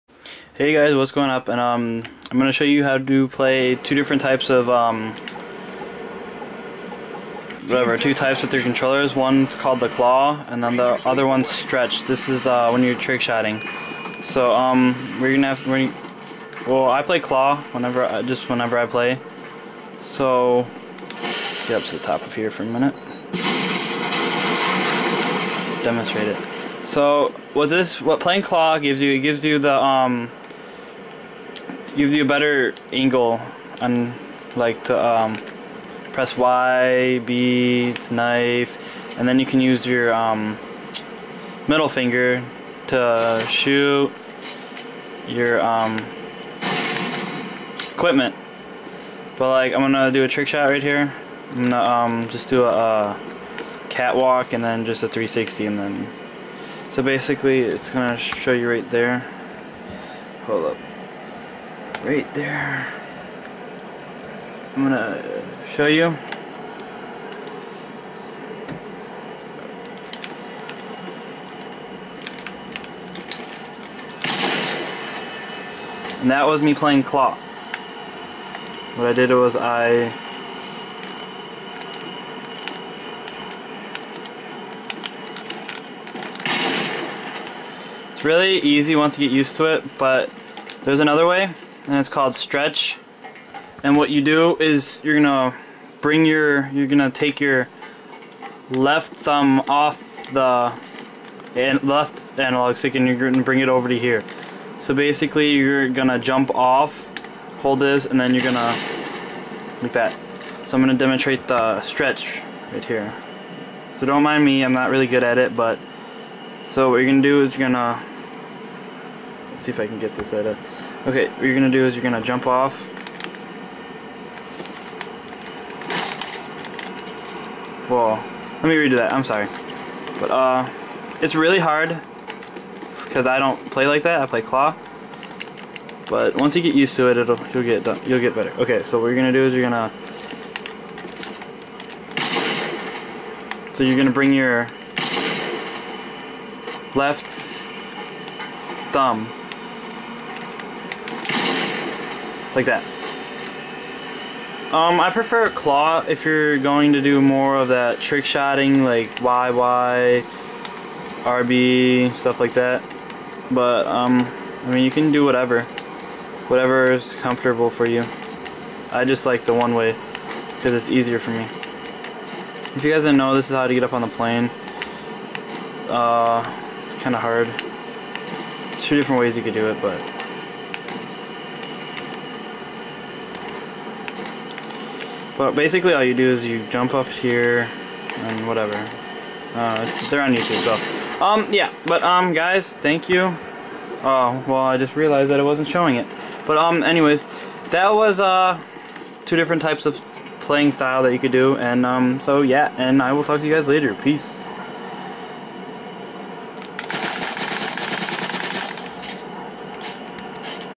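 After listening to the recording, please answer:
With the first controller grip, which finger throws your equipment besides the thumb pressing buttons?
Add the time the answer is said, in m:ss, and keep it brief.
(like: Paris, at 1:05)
Middle finger, at 0:41.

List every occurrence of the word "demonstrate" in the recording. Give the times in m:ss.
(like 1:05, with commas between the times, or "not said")
0:25, 1:50.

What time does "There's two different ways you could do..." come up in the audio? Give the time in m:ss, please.
2:57.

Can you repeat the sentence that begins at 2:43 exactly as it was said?
But, um, I mean, you can do whatever.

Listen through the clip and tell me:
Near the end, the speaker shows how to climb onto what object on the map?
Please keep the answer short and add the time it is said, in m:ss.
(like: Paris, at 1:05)
The plane, at 2:54.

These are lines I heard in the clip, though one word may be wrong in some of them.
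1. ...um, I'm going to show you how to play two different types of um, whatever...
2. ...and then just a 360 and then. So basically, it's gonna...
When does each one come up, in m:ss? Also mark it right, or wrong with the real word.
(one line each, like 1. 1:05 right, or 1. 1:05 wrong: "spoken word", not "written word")
1. 0:01 right
2. 0:54 right.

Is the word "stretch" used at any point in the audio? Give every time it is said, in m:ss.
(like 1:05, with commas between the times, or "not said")
0:11, 1:32, 1:51.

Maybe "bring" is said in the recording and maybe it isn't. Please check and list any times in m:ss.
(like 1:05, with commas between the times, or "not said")
1:36, 1:43, 2:24.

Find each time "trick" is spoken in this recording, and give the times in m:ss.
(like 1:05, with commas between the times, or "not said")
0:12, 0:50, 2:37.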